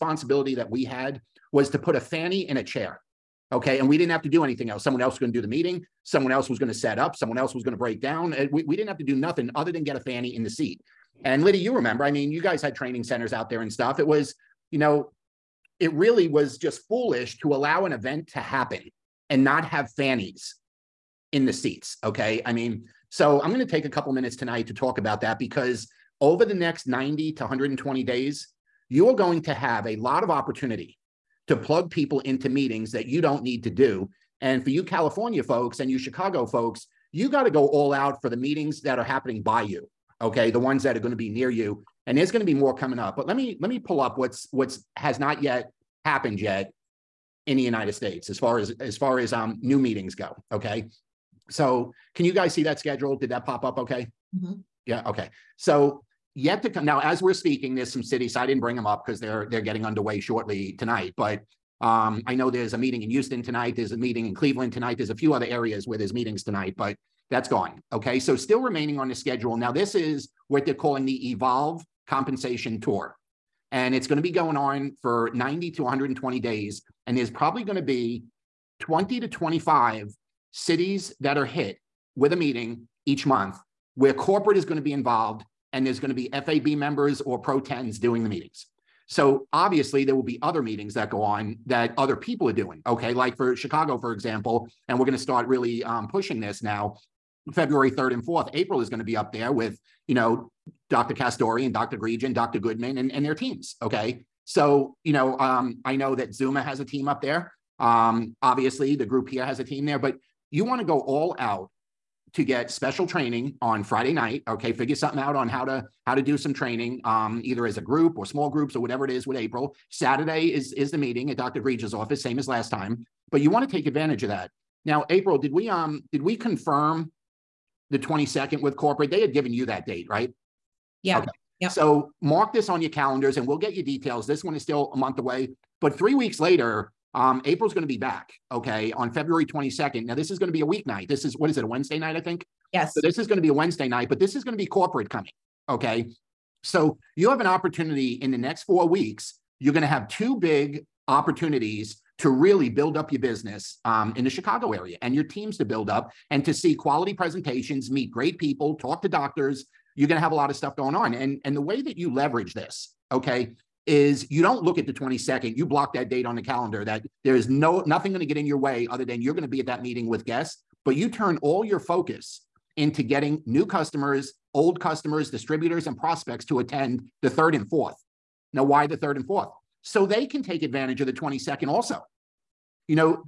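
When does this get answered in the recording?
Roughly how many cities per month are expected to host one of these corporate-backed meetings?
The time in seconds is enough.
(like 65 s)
78 s.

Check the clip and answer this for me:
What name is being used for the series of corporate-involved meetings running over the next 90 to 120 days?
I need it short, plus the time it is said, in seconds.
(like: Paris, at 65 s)
Evolve Compensation Tour, at 71 s.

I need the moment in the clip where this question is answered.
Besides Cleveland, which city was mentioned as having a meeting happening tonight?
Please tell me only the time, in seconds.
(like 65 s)
63 s.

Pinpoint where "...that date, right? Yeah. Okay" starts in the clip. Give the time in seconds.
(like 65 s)
129 s.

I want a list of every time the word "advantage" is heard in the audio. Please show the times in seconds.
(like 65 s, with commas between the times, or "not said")
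123 s, 180 s.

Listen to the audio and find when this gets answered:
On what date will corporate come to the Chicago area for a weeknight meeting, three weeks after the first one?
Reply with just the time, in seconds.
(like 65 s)
139 s.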